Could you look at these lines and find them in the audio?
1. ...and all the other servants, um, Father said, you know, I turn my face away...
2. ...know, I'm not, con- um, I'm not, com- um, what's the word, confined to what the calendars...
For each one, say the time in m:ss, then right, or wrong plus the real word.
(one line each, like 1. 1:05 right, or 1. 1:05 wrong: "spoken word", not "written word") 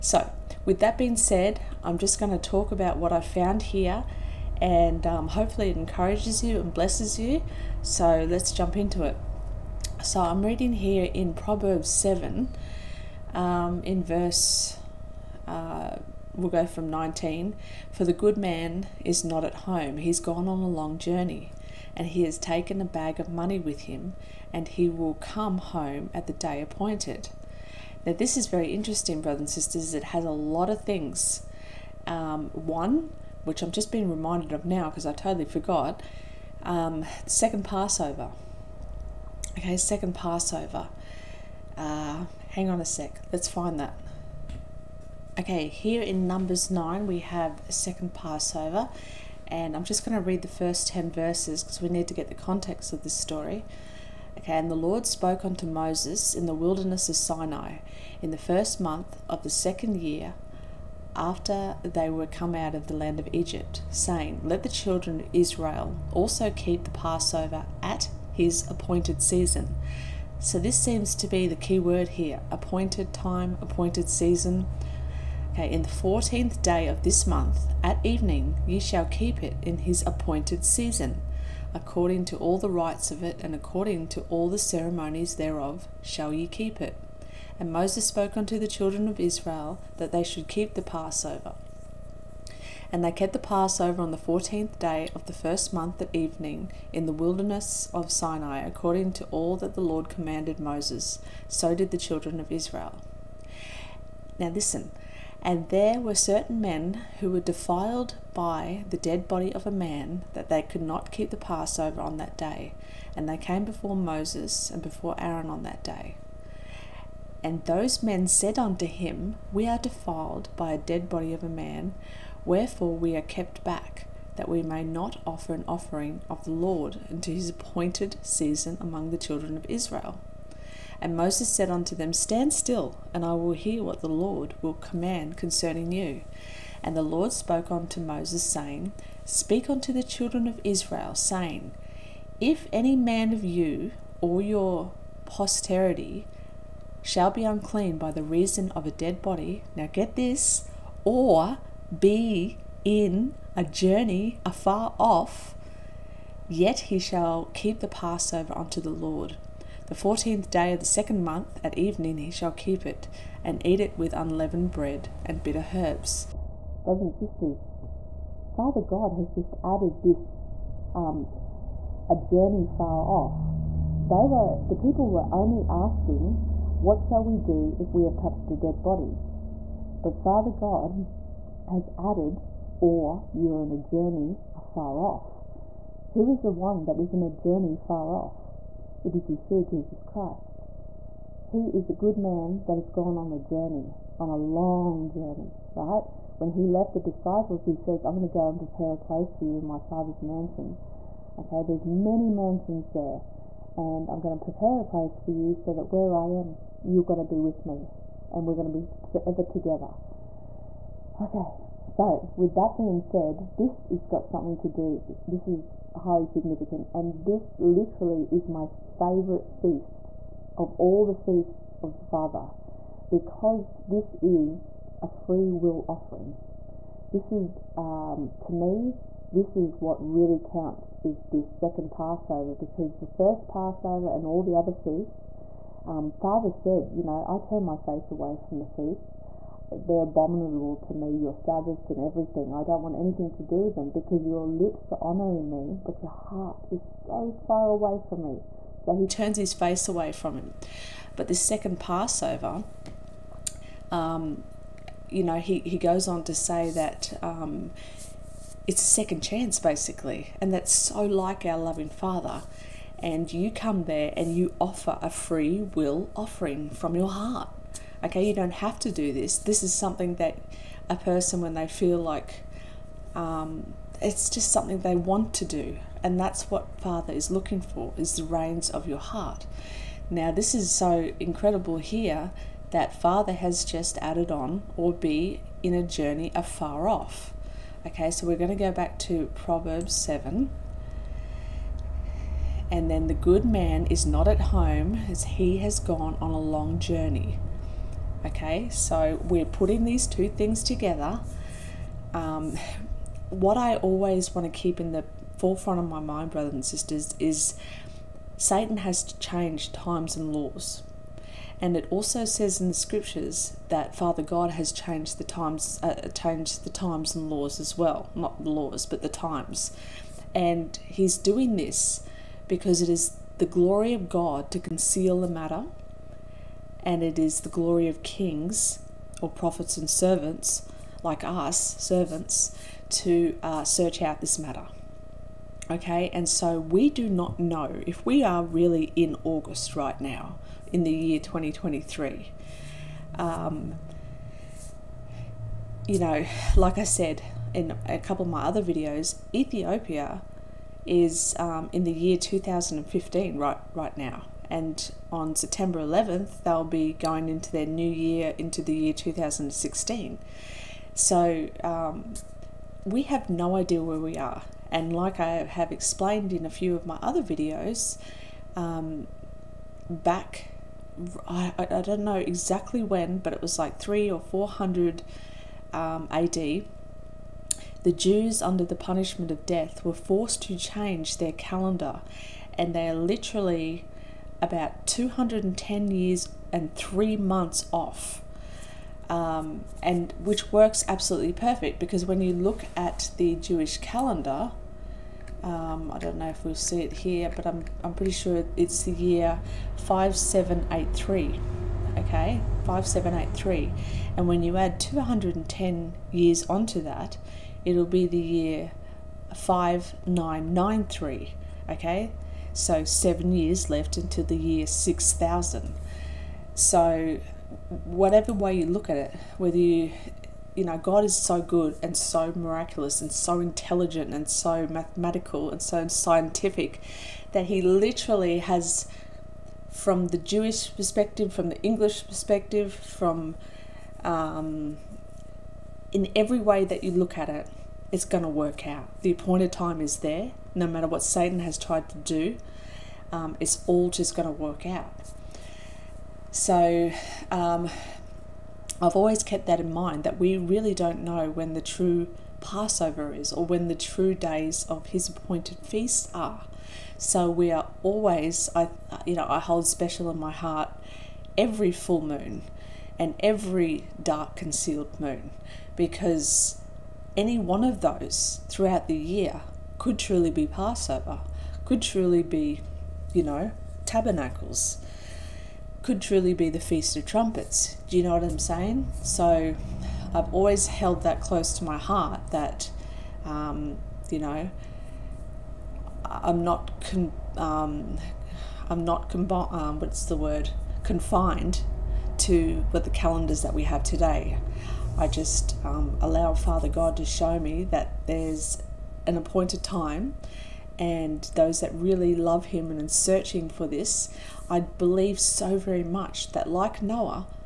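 1. 3:54 wrong: "feasts", not "servants"
2. 8:04 right.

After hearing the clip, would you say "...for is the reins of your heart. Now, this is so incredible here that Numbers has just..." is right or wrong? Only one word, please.
wrong.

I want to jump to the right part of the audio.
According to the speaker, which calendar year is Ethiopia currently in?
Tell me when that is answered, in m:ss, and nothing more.
5:52.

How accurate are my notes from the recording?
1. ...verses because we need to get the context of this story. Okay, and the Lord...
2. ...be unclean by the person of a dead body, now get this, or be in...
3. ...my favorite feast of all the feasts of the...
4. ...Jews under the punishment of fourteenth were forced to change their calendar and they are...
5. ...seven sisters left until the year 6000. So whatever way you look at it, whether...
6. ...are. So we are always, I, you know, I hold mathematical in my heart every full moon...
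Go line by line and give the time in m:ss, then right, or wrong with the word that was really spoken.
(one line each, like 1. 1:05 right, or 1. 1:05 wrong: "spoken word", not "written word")
1. 0:51 right
2. 2:27 wrong: "reason", not "person"
3. 3:38 right
4. 6:17 wrong: "death", not "fourteenth"
5. 6:52 wrong: "years", not "sisters"
6. 7:36 wrong: "special", not "mathematical".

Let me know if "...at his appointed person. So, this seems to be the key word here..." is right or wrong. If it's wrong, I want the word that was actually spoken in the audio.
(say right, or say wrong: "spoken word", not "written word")
wrong: "season", not "person".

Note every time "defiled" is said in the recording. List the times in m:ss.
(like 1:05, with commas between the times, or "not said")
1:47, 1:59.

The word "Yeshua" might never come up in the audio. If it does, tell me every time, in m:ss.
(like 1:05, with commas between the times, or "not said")
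3:09.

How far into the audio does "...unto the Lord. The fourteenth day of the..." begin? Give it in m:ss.
2:38.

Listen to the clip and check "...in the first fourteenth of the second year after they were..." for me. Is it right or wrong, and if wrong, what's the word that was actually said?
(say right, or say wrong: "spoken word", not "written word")
wrong: "month", not "fourteenth".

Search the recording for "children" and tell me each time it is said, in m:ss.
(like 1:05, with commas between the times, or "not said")
1:04, 1:28, 1:41, 2:09, 2:20.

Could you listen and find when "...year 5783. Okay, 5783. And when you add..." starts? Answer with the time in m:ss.
6:38.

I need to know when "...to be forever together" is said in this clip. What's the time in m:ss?
3:28.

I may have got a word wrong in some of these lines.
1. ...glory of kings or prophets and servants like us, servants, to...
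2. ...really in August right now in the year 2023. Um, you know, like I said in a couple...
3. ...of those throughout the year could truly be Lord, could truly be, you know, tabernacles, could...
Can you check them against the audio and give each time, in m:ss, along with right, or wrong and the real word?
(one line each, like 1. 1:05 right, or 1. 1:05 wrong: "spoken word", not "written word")
1. 5:27 right
2. 5:38 right
3. 7:47 wrong: "Passover", not "Lord".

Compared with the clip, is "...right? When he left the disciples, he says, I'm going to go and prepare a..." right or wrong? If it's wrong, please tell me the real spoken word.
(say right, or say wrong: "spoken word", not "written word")
right.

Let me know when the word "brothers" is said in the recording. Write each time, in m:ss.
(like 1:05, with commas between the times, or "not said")
0:29, 2:46, 5:06.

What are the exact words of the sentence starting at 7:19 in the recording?
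The appointed time is there no matter what Satan has tried to do, um, it's all just going to work out.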